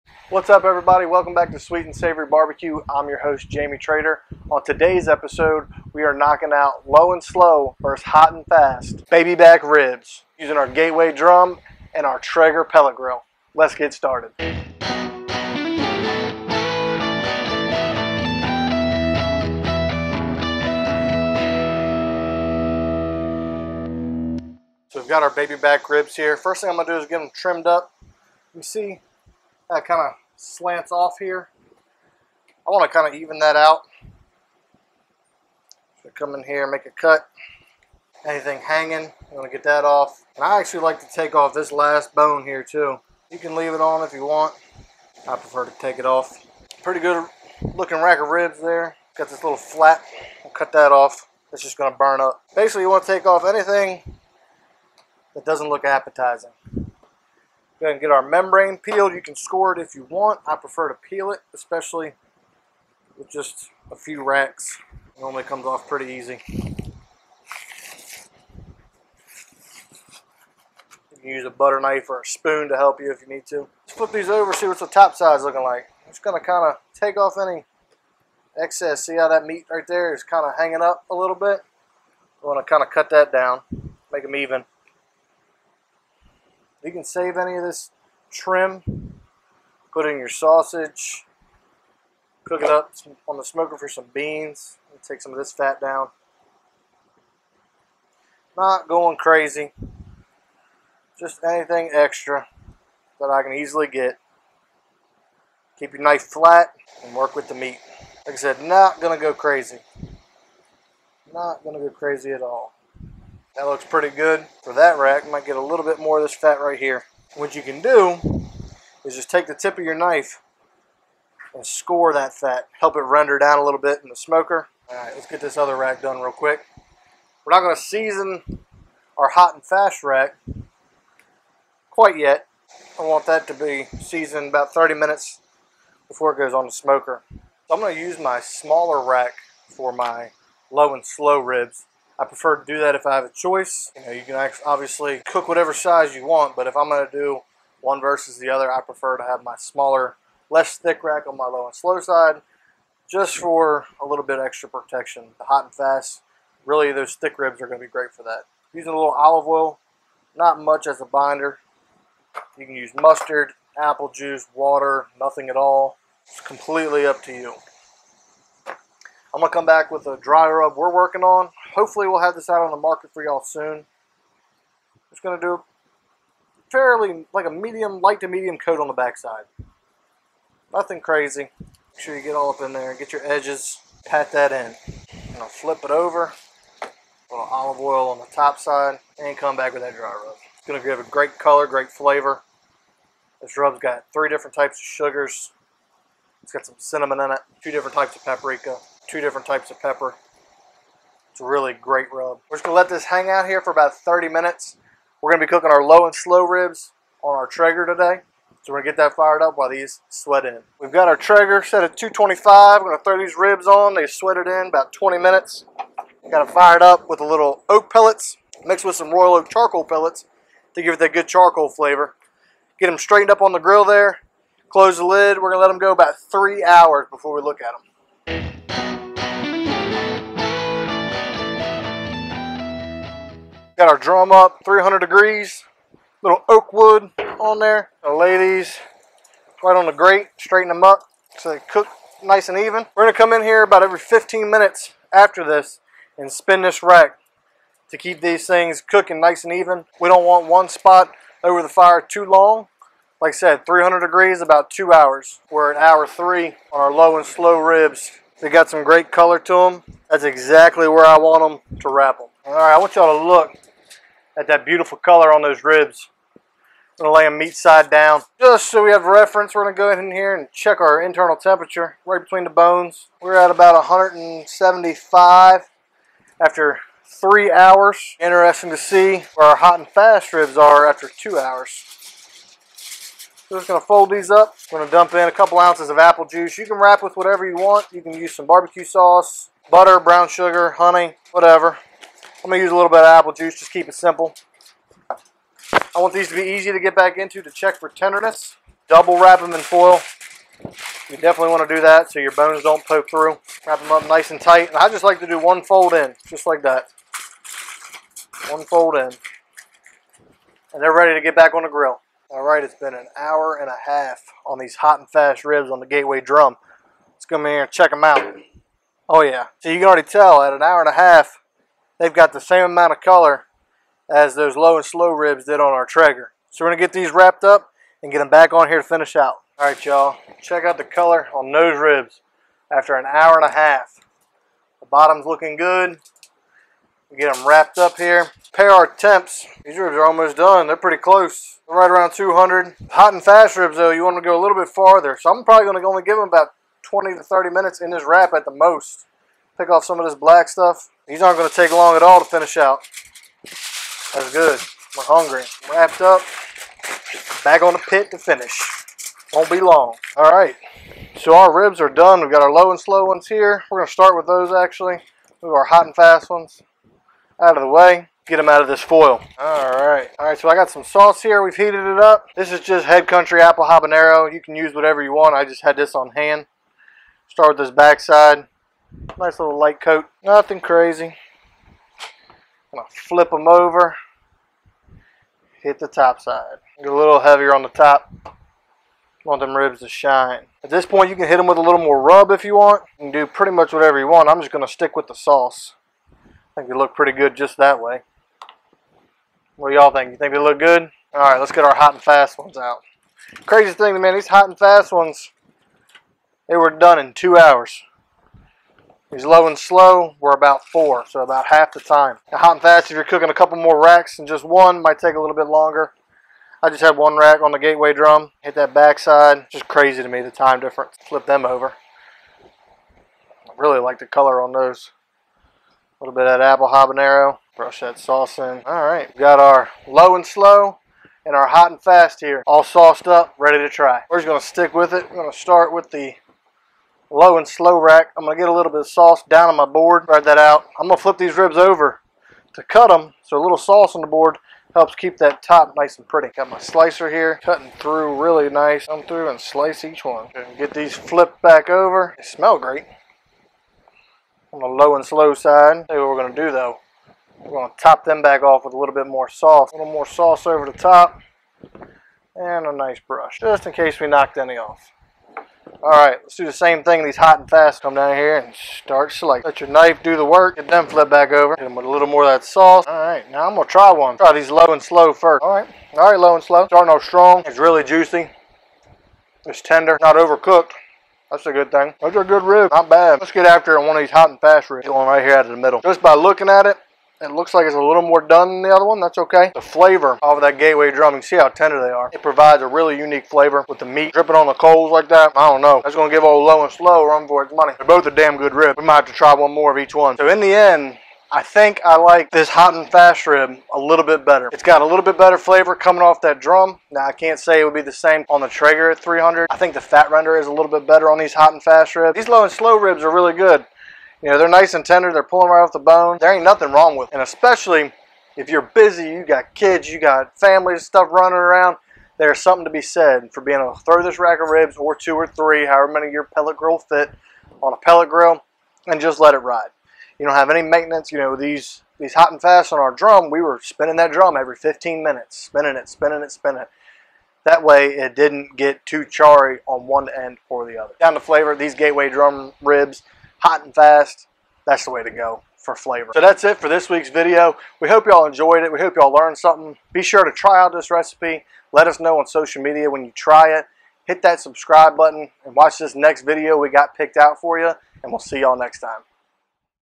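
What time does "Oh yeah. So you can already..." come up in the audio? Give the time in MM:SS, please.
05:19.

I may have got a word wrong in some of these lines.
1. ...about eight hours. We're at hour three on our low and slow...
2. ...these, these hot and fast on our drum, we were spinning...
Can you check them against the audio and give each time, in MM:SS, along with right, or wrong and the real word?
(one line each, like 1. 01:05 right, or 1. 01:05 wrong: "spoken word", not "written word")
1. 04:14 wrong: "two", not "eight"
2. 08:51 right.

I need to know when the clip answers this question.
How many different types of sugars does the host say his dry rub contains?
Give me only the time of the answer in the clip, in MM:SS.
03:14.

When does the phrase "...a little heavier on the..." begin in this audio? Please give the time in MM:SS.
06:26.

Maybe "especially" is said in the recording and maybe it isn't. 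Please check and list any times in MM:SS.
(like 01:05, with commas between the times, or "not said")
01:01, 08:37.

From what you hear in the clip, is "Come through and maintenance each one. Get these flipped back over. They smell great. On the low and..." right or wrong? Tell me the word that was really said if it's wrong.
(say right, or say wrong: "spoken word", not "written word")
wrong: "slice", not "maintenance".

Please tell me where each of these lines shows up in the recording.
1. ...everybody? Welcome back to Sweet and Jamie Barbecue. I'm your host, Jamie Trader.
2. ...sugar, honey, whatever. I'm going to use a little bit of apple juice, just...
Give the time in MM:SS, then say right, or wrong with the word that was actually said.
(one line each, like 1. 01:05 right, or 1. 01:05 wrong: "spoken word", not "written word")
1. 00:00 wrong: "Savory", not "Jamie"
2. 04:50 right.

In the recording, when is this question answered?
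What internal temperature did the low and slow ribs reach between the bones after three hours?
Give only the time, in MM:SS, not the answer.
04:33.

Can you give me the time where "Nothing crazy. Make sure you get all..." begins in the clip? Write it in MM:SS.
03:00.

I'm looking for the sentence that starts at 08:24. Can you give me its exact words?
It's got a little bit better flavor coming off that drum.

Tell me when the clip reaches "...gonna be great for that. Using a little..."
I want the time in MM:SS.
02:37.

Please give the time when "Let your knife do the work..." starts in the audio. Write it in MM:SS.
07:49.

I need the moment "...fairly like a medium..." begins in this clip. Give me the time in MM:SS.
02:56.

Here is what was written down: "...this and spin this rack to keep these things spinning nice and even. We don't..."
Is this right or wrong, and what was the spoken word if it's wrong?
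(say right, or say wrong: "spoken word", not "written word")
wrong: "cooking", not "spinning".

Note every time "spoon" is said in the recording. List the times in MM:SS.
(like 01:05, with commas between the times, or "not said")
01:12.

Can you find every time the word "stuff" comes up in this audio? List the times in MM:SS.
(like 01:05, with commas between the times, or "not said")
05:50, 08:40.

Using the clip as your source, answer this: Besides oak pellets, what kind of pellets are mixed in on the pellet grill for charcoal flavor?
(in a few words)
Royal Oak charcoal pellets.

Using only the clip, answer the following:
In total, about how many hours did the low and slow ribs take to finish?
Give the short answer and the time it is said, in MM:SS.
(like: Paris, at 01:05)
About 4 hours, at 06:50.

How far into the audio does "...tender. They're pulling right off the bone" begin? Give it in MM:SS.
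08:34.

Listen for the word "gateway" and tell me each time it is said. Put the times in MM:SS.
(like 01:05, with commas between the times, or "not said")
00:10, 05:15, 06:57, 08:10, 09:01.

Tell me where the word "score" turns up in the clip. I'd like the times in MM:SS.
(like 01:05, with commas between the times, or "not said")
00:59, 02:01.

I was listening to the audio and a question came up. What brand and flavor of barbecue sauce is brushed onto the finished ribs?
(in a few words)
Head Country apple habanero.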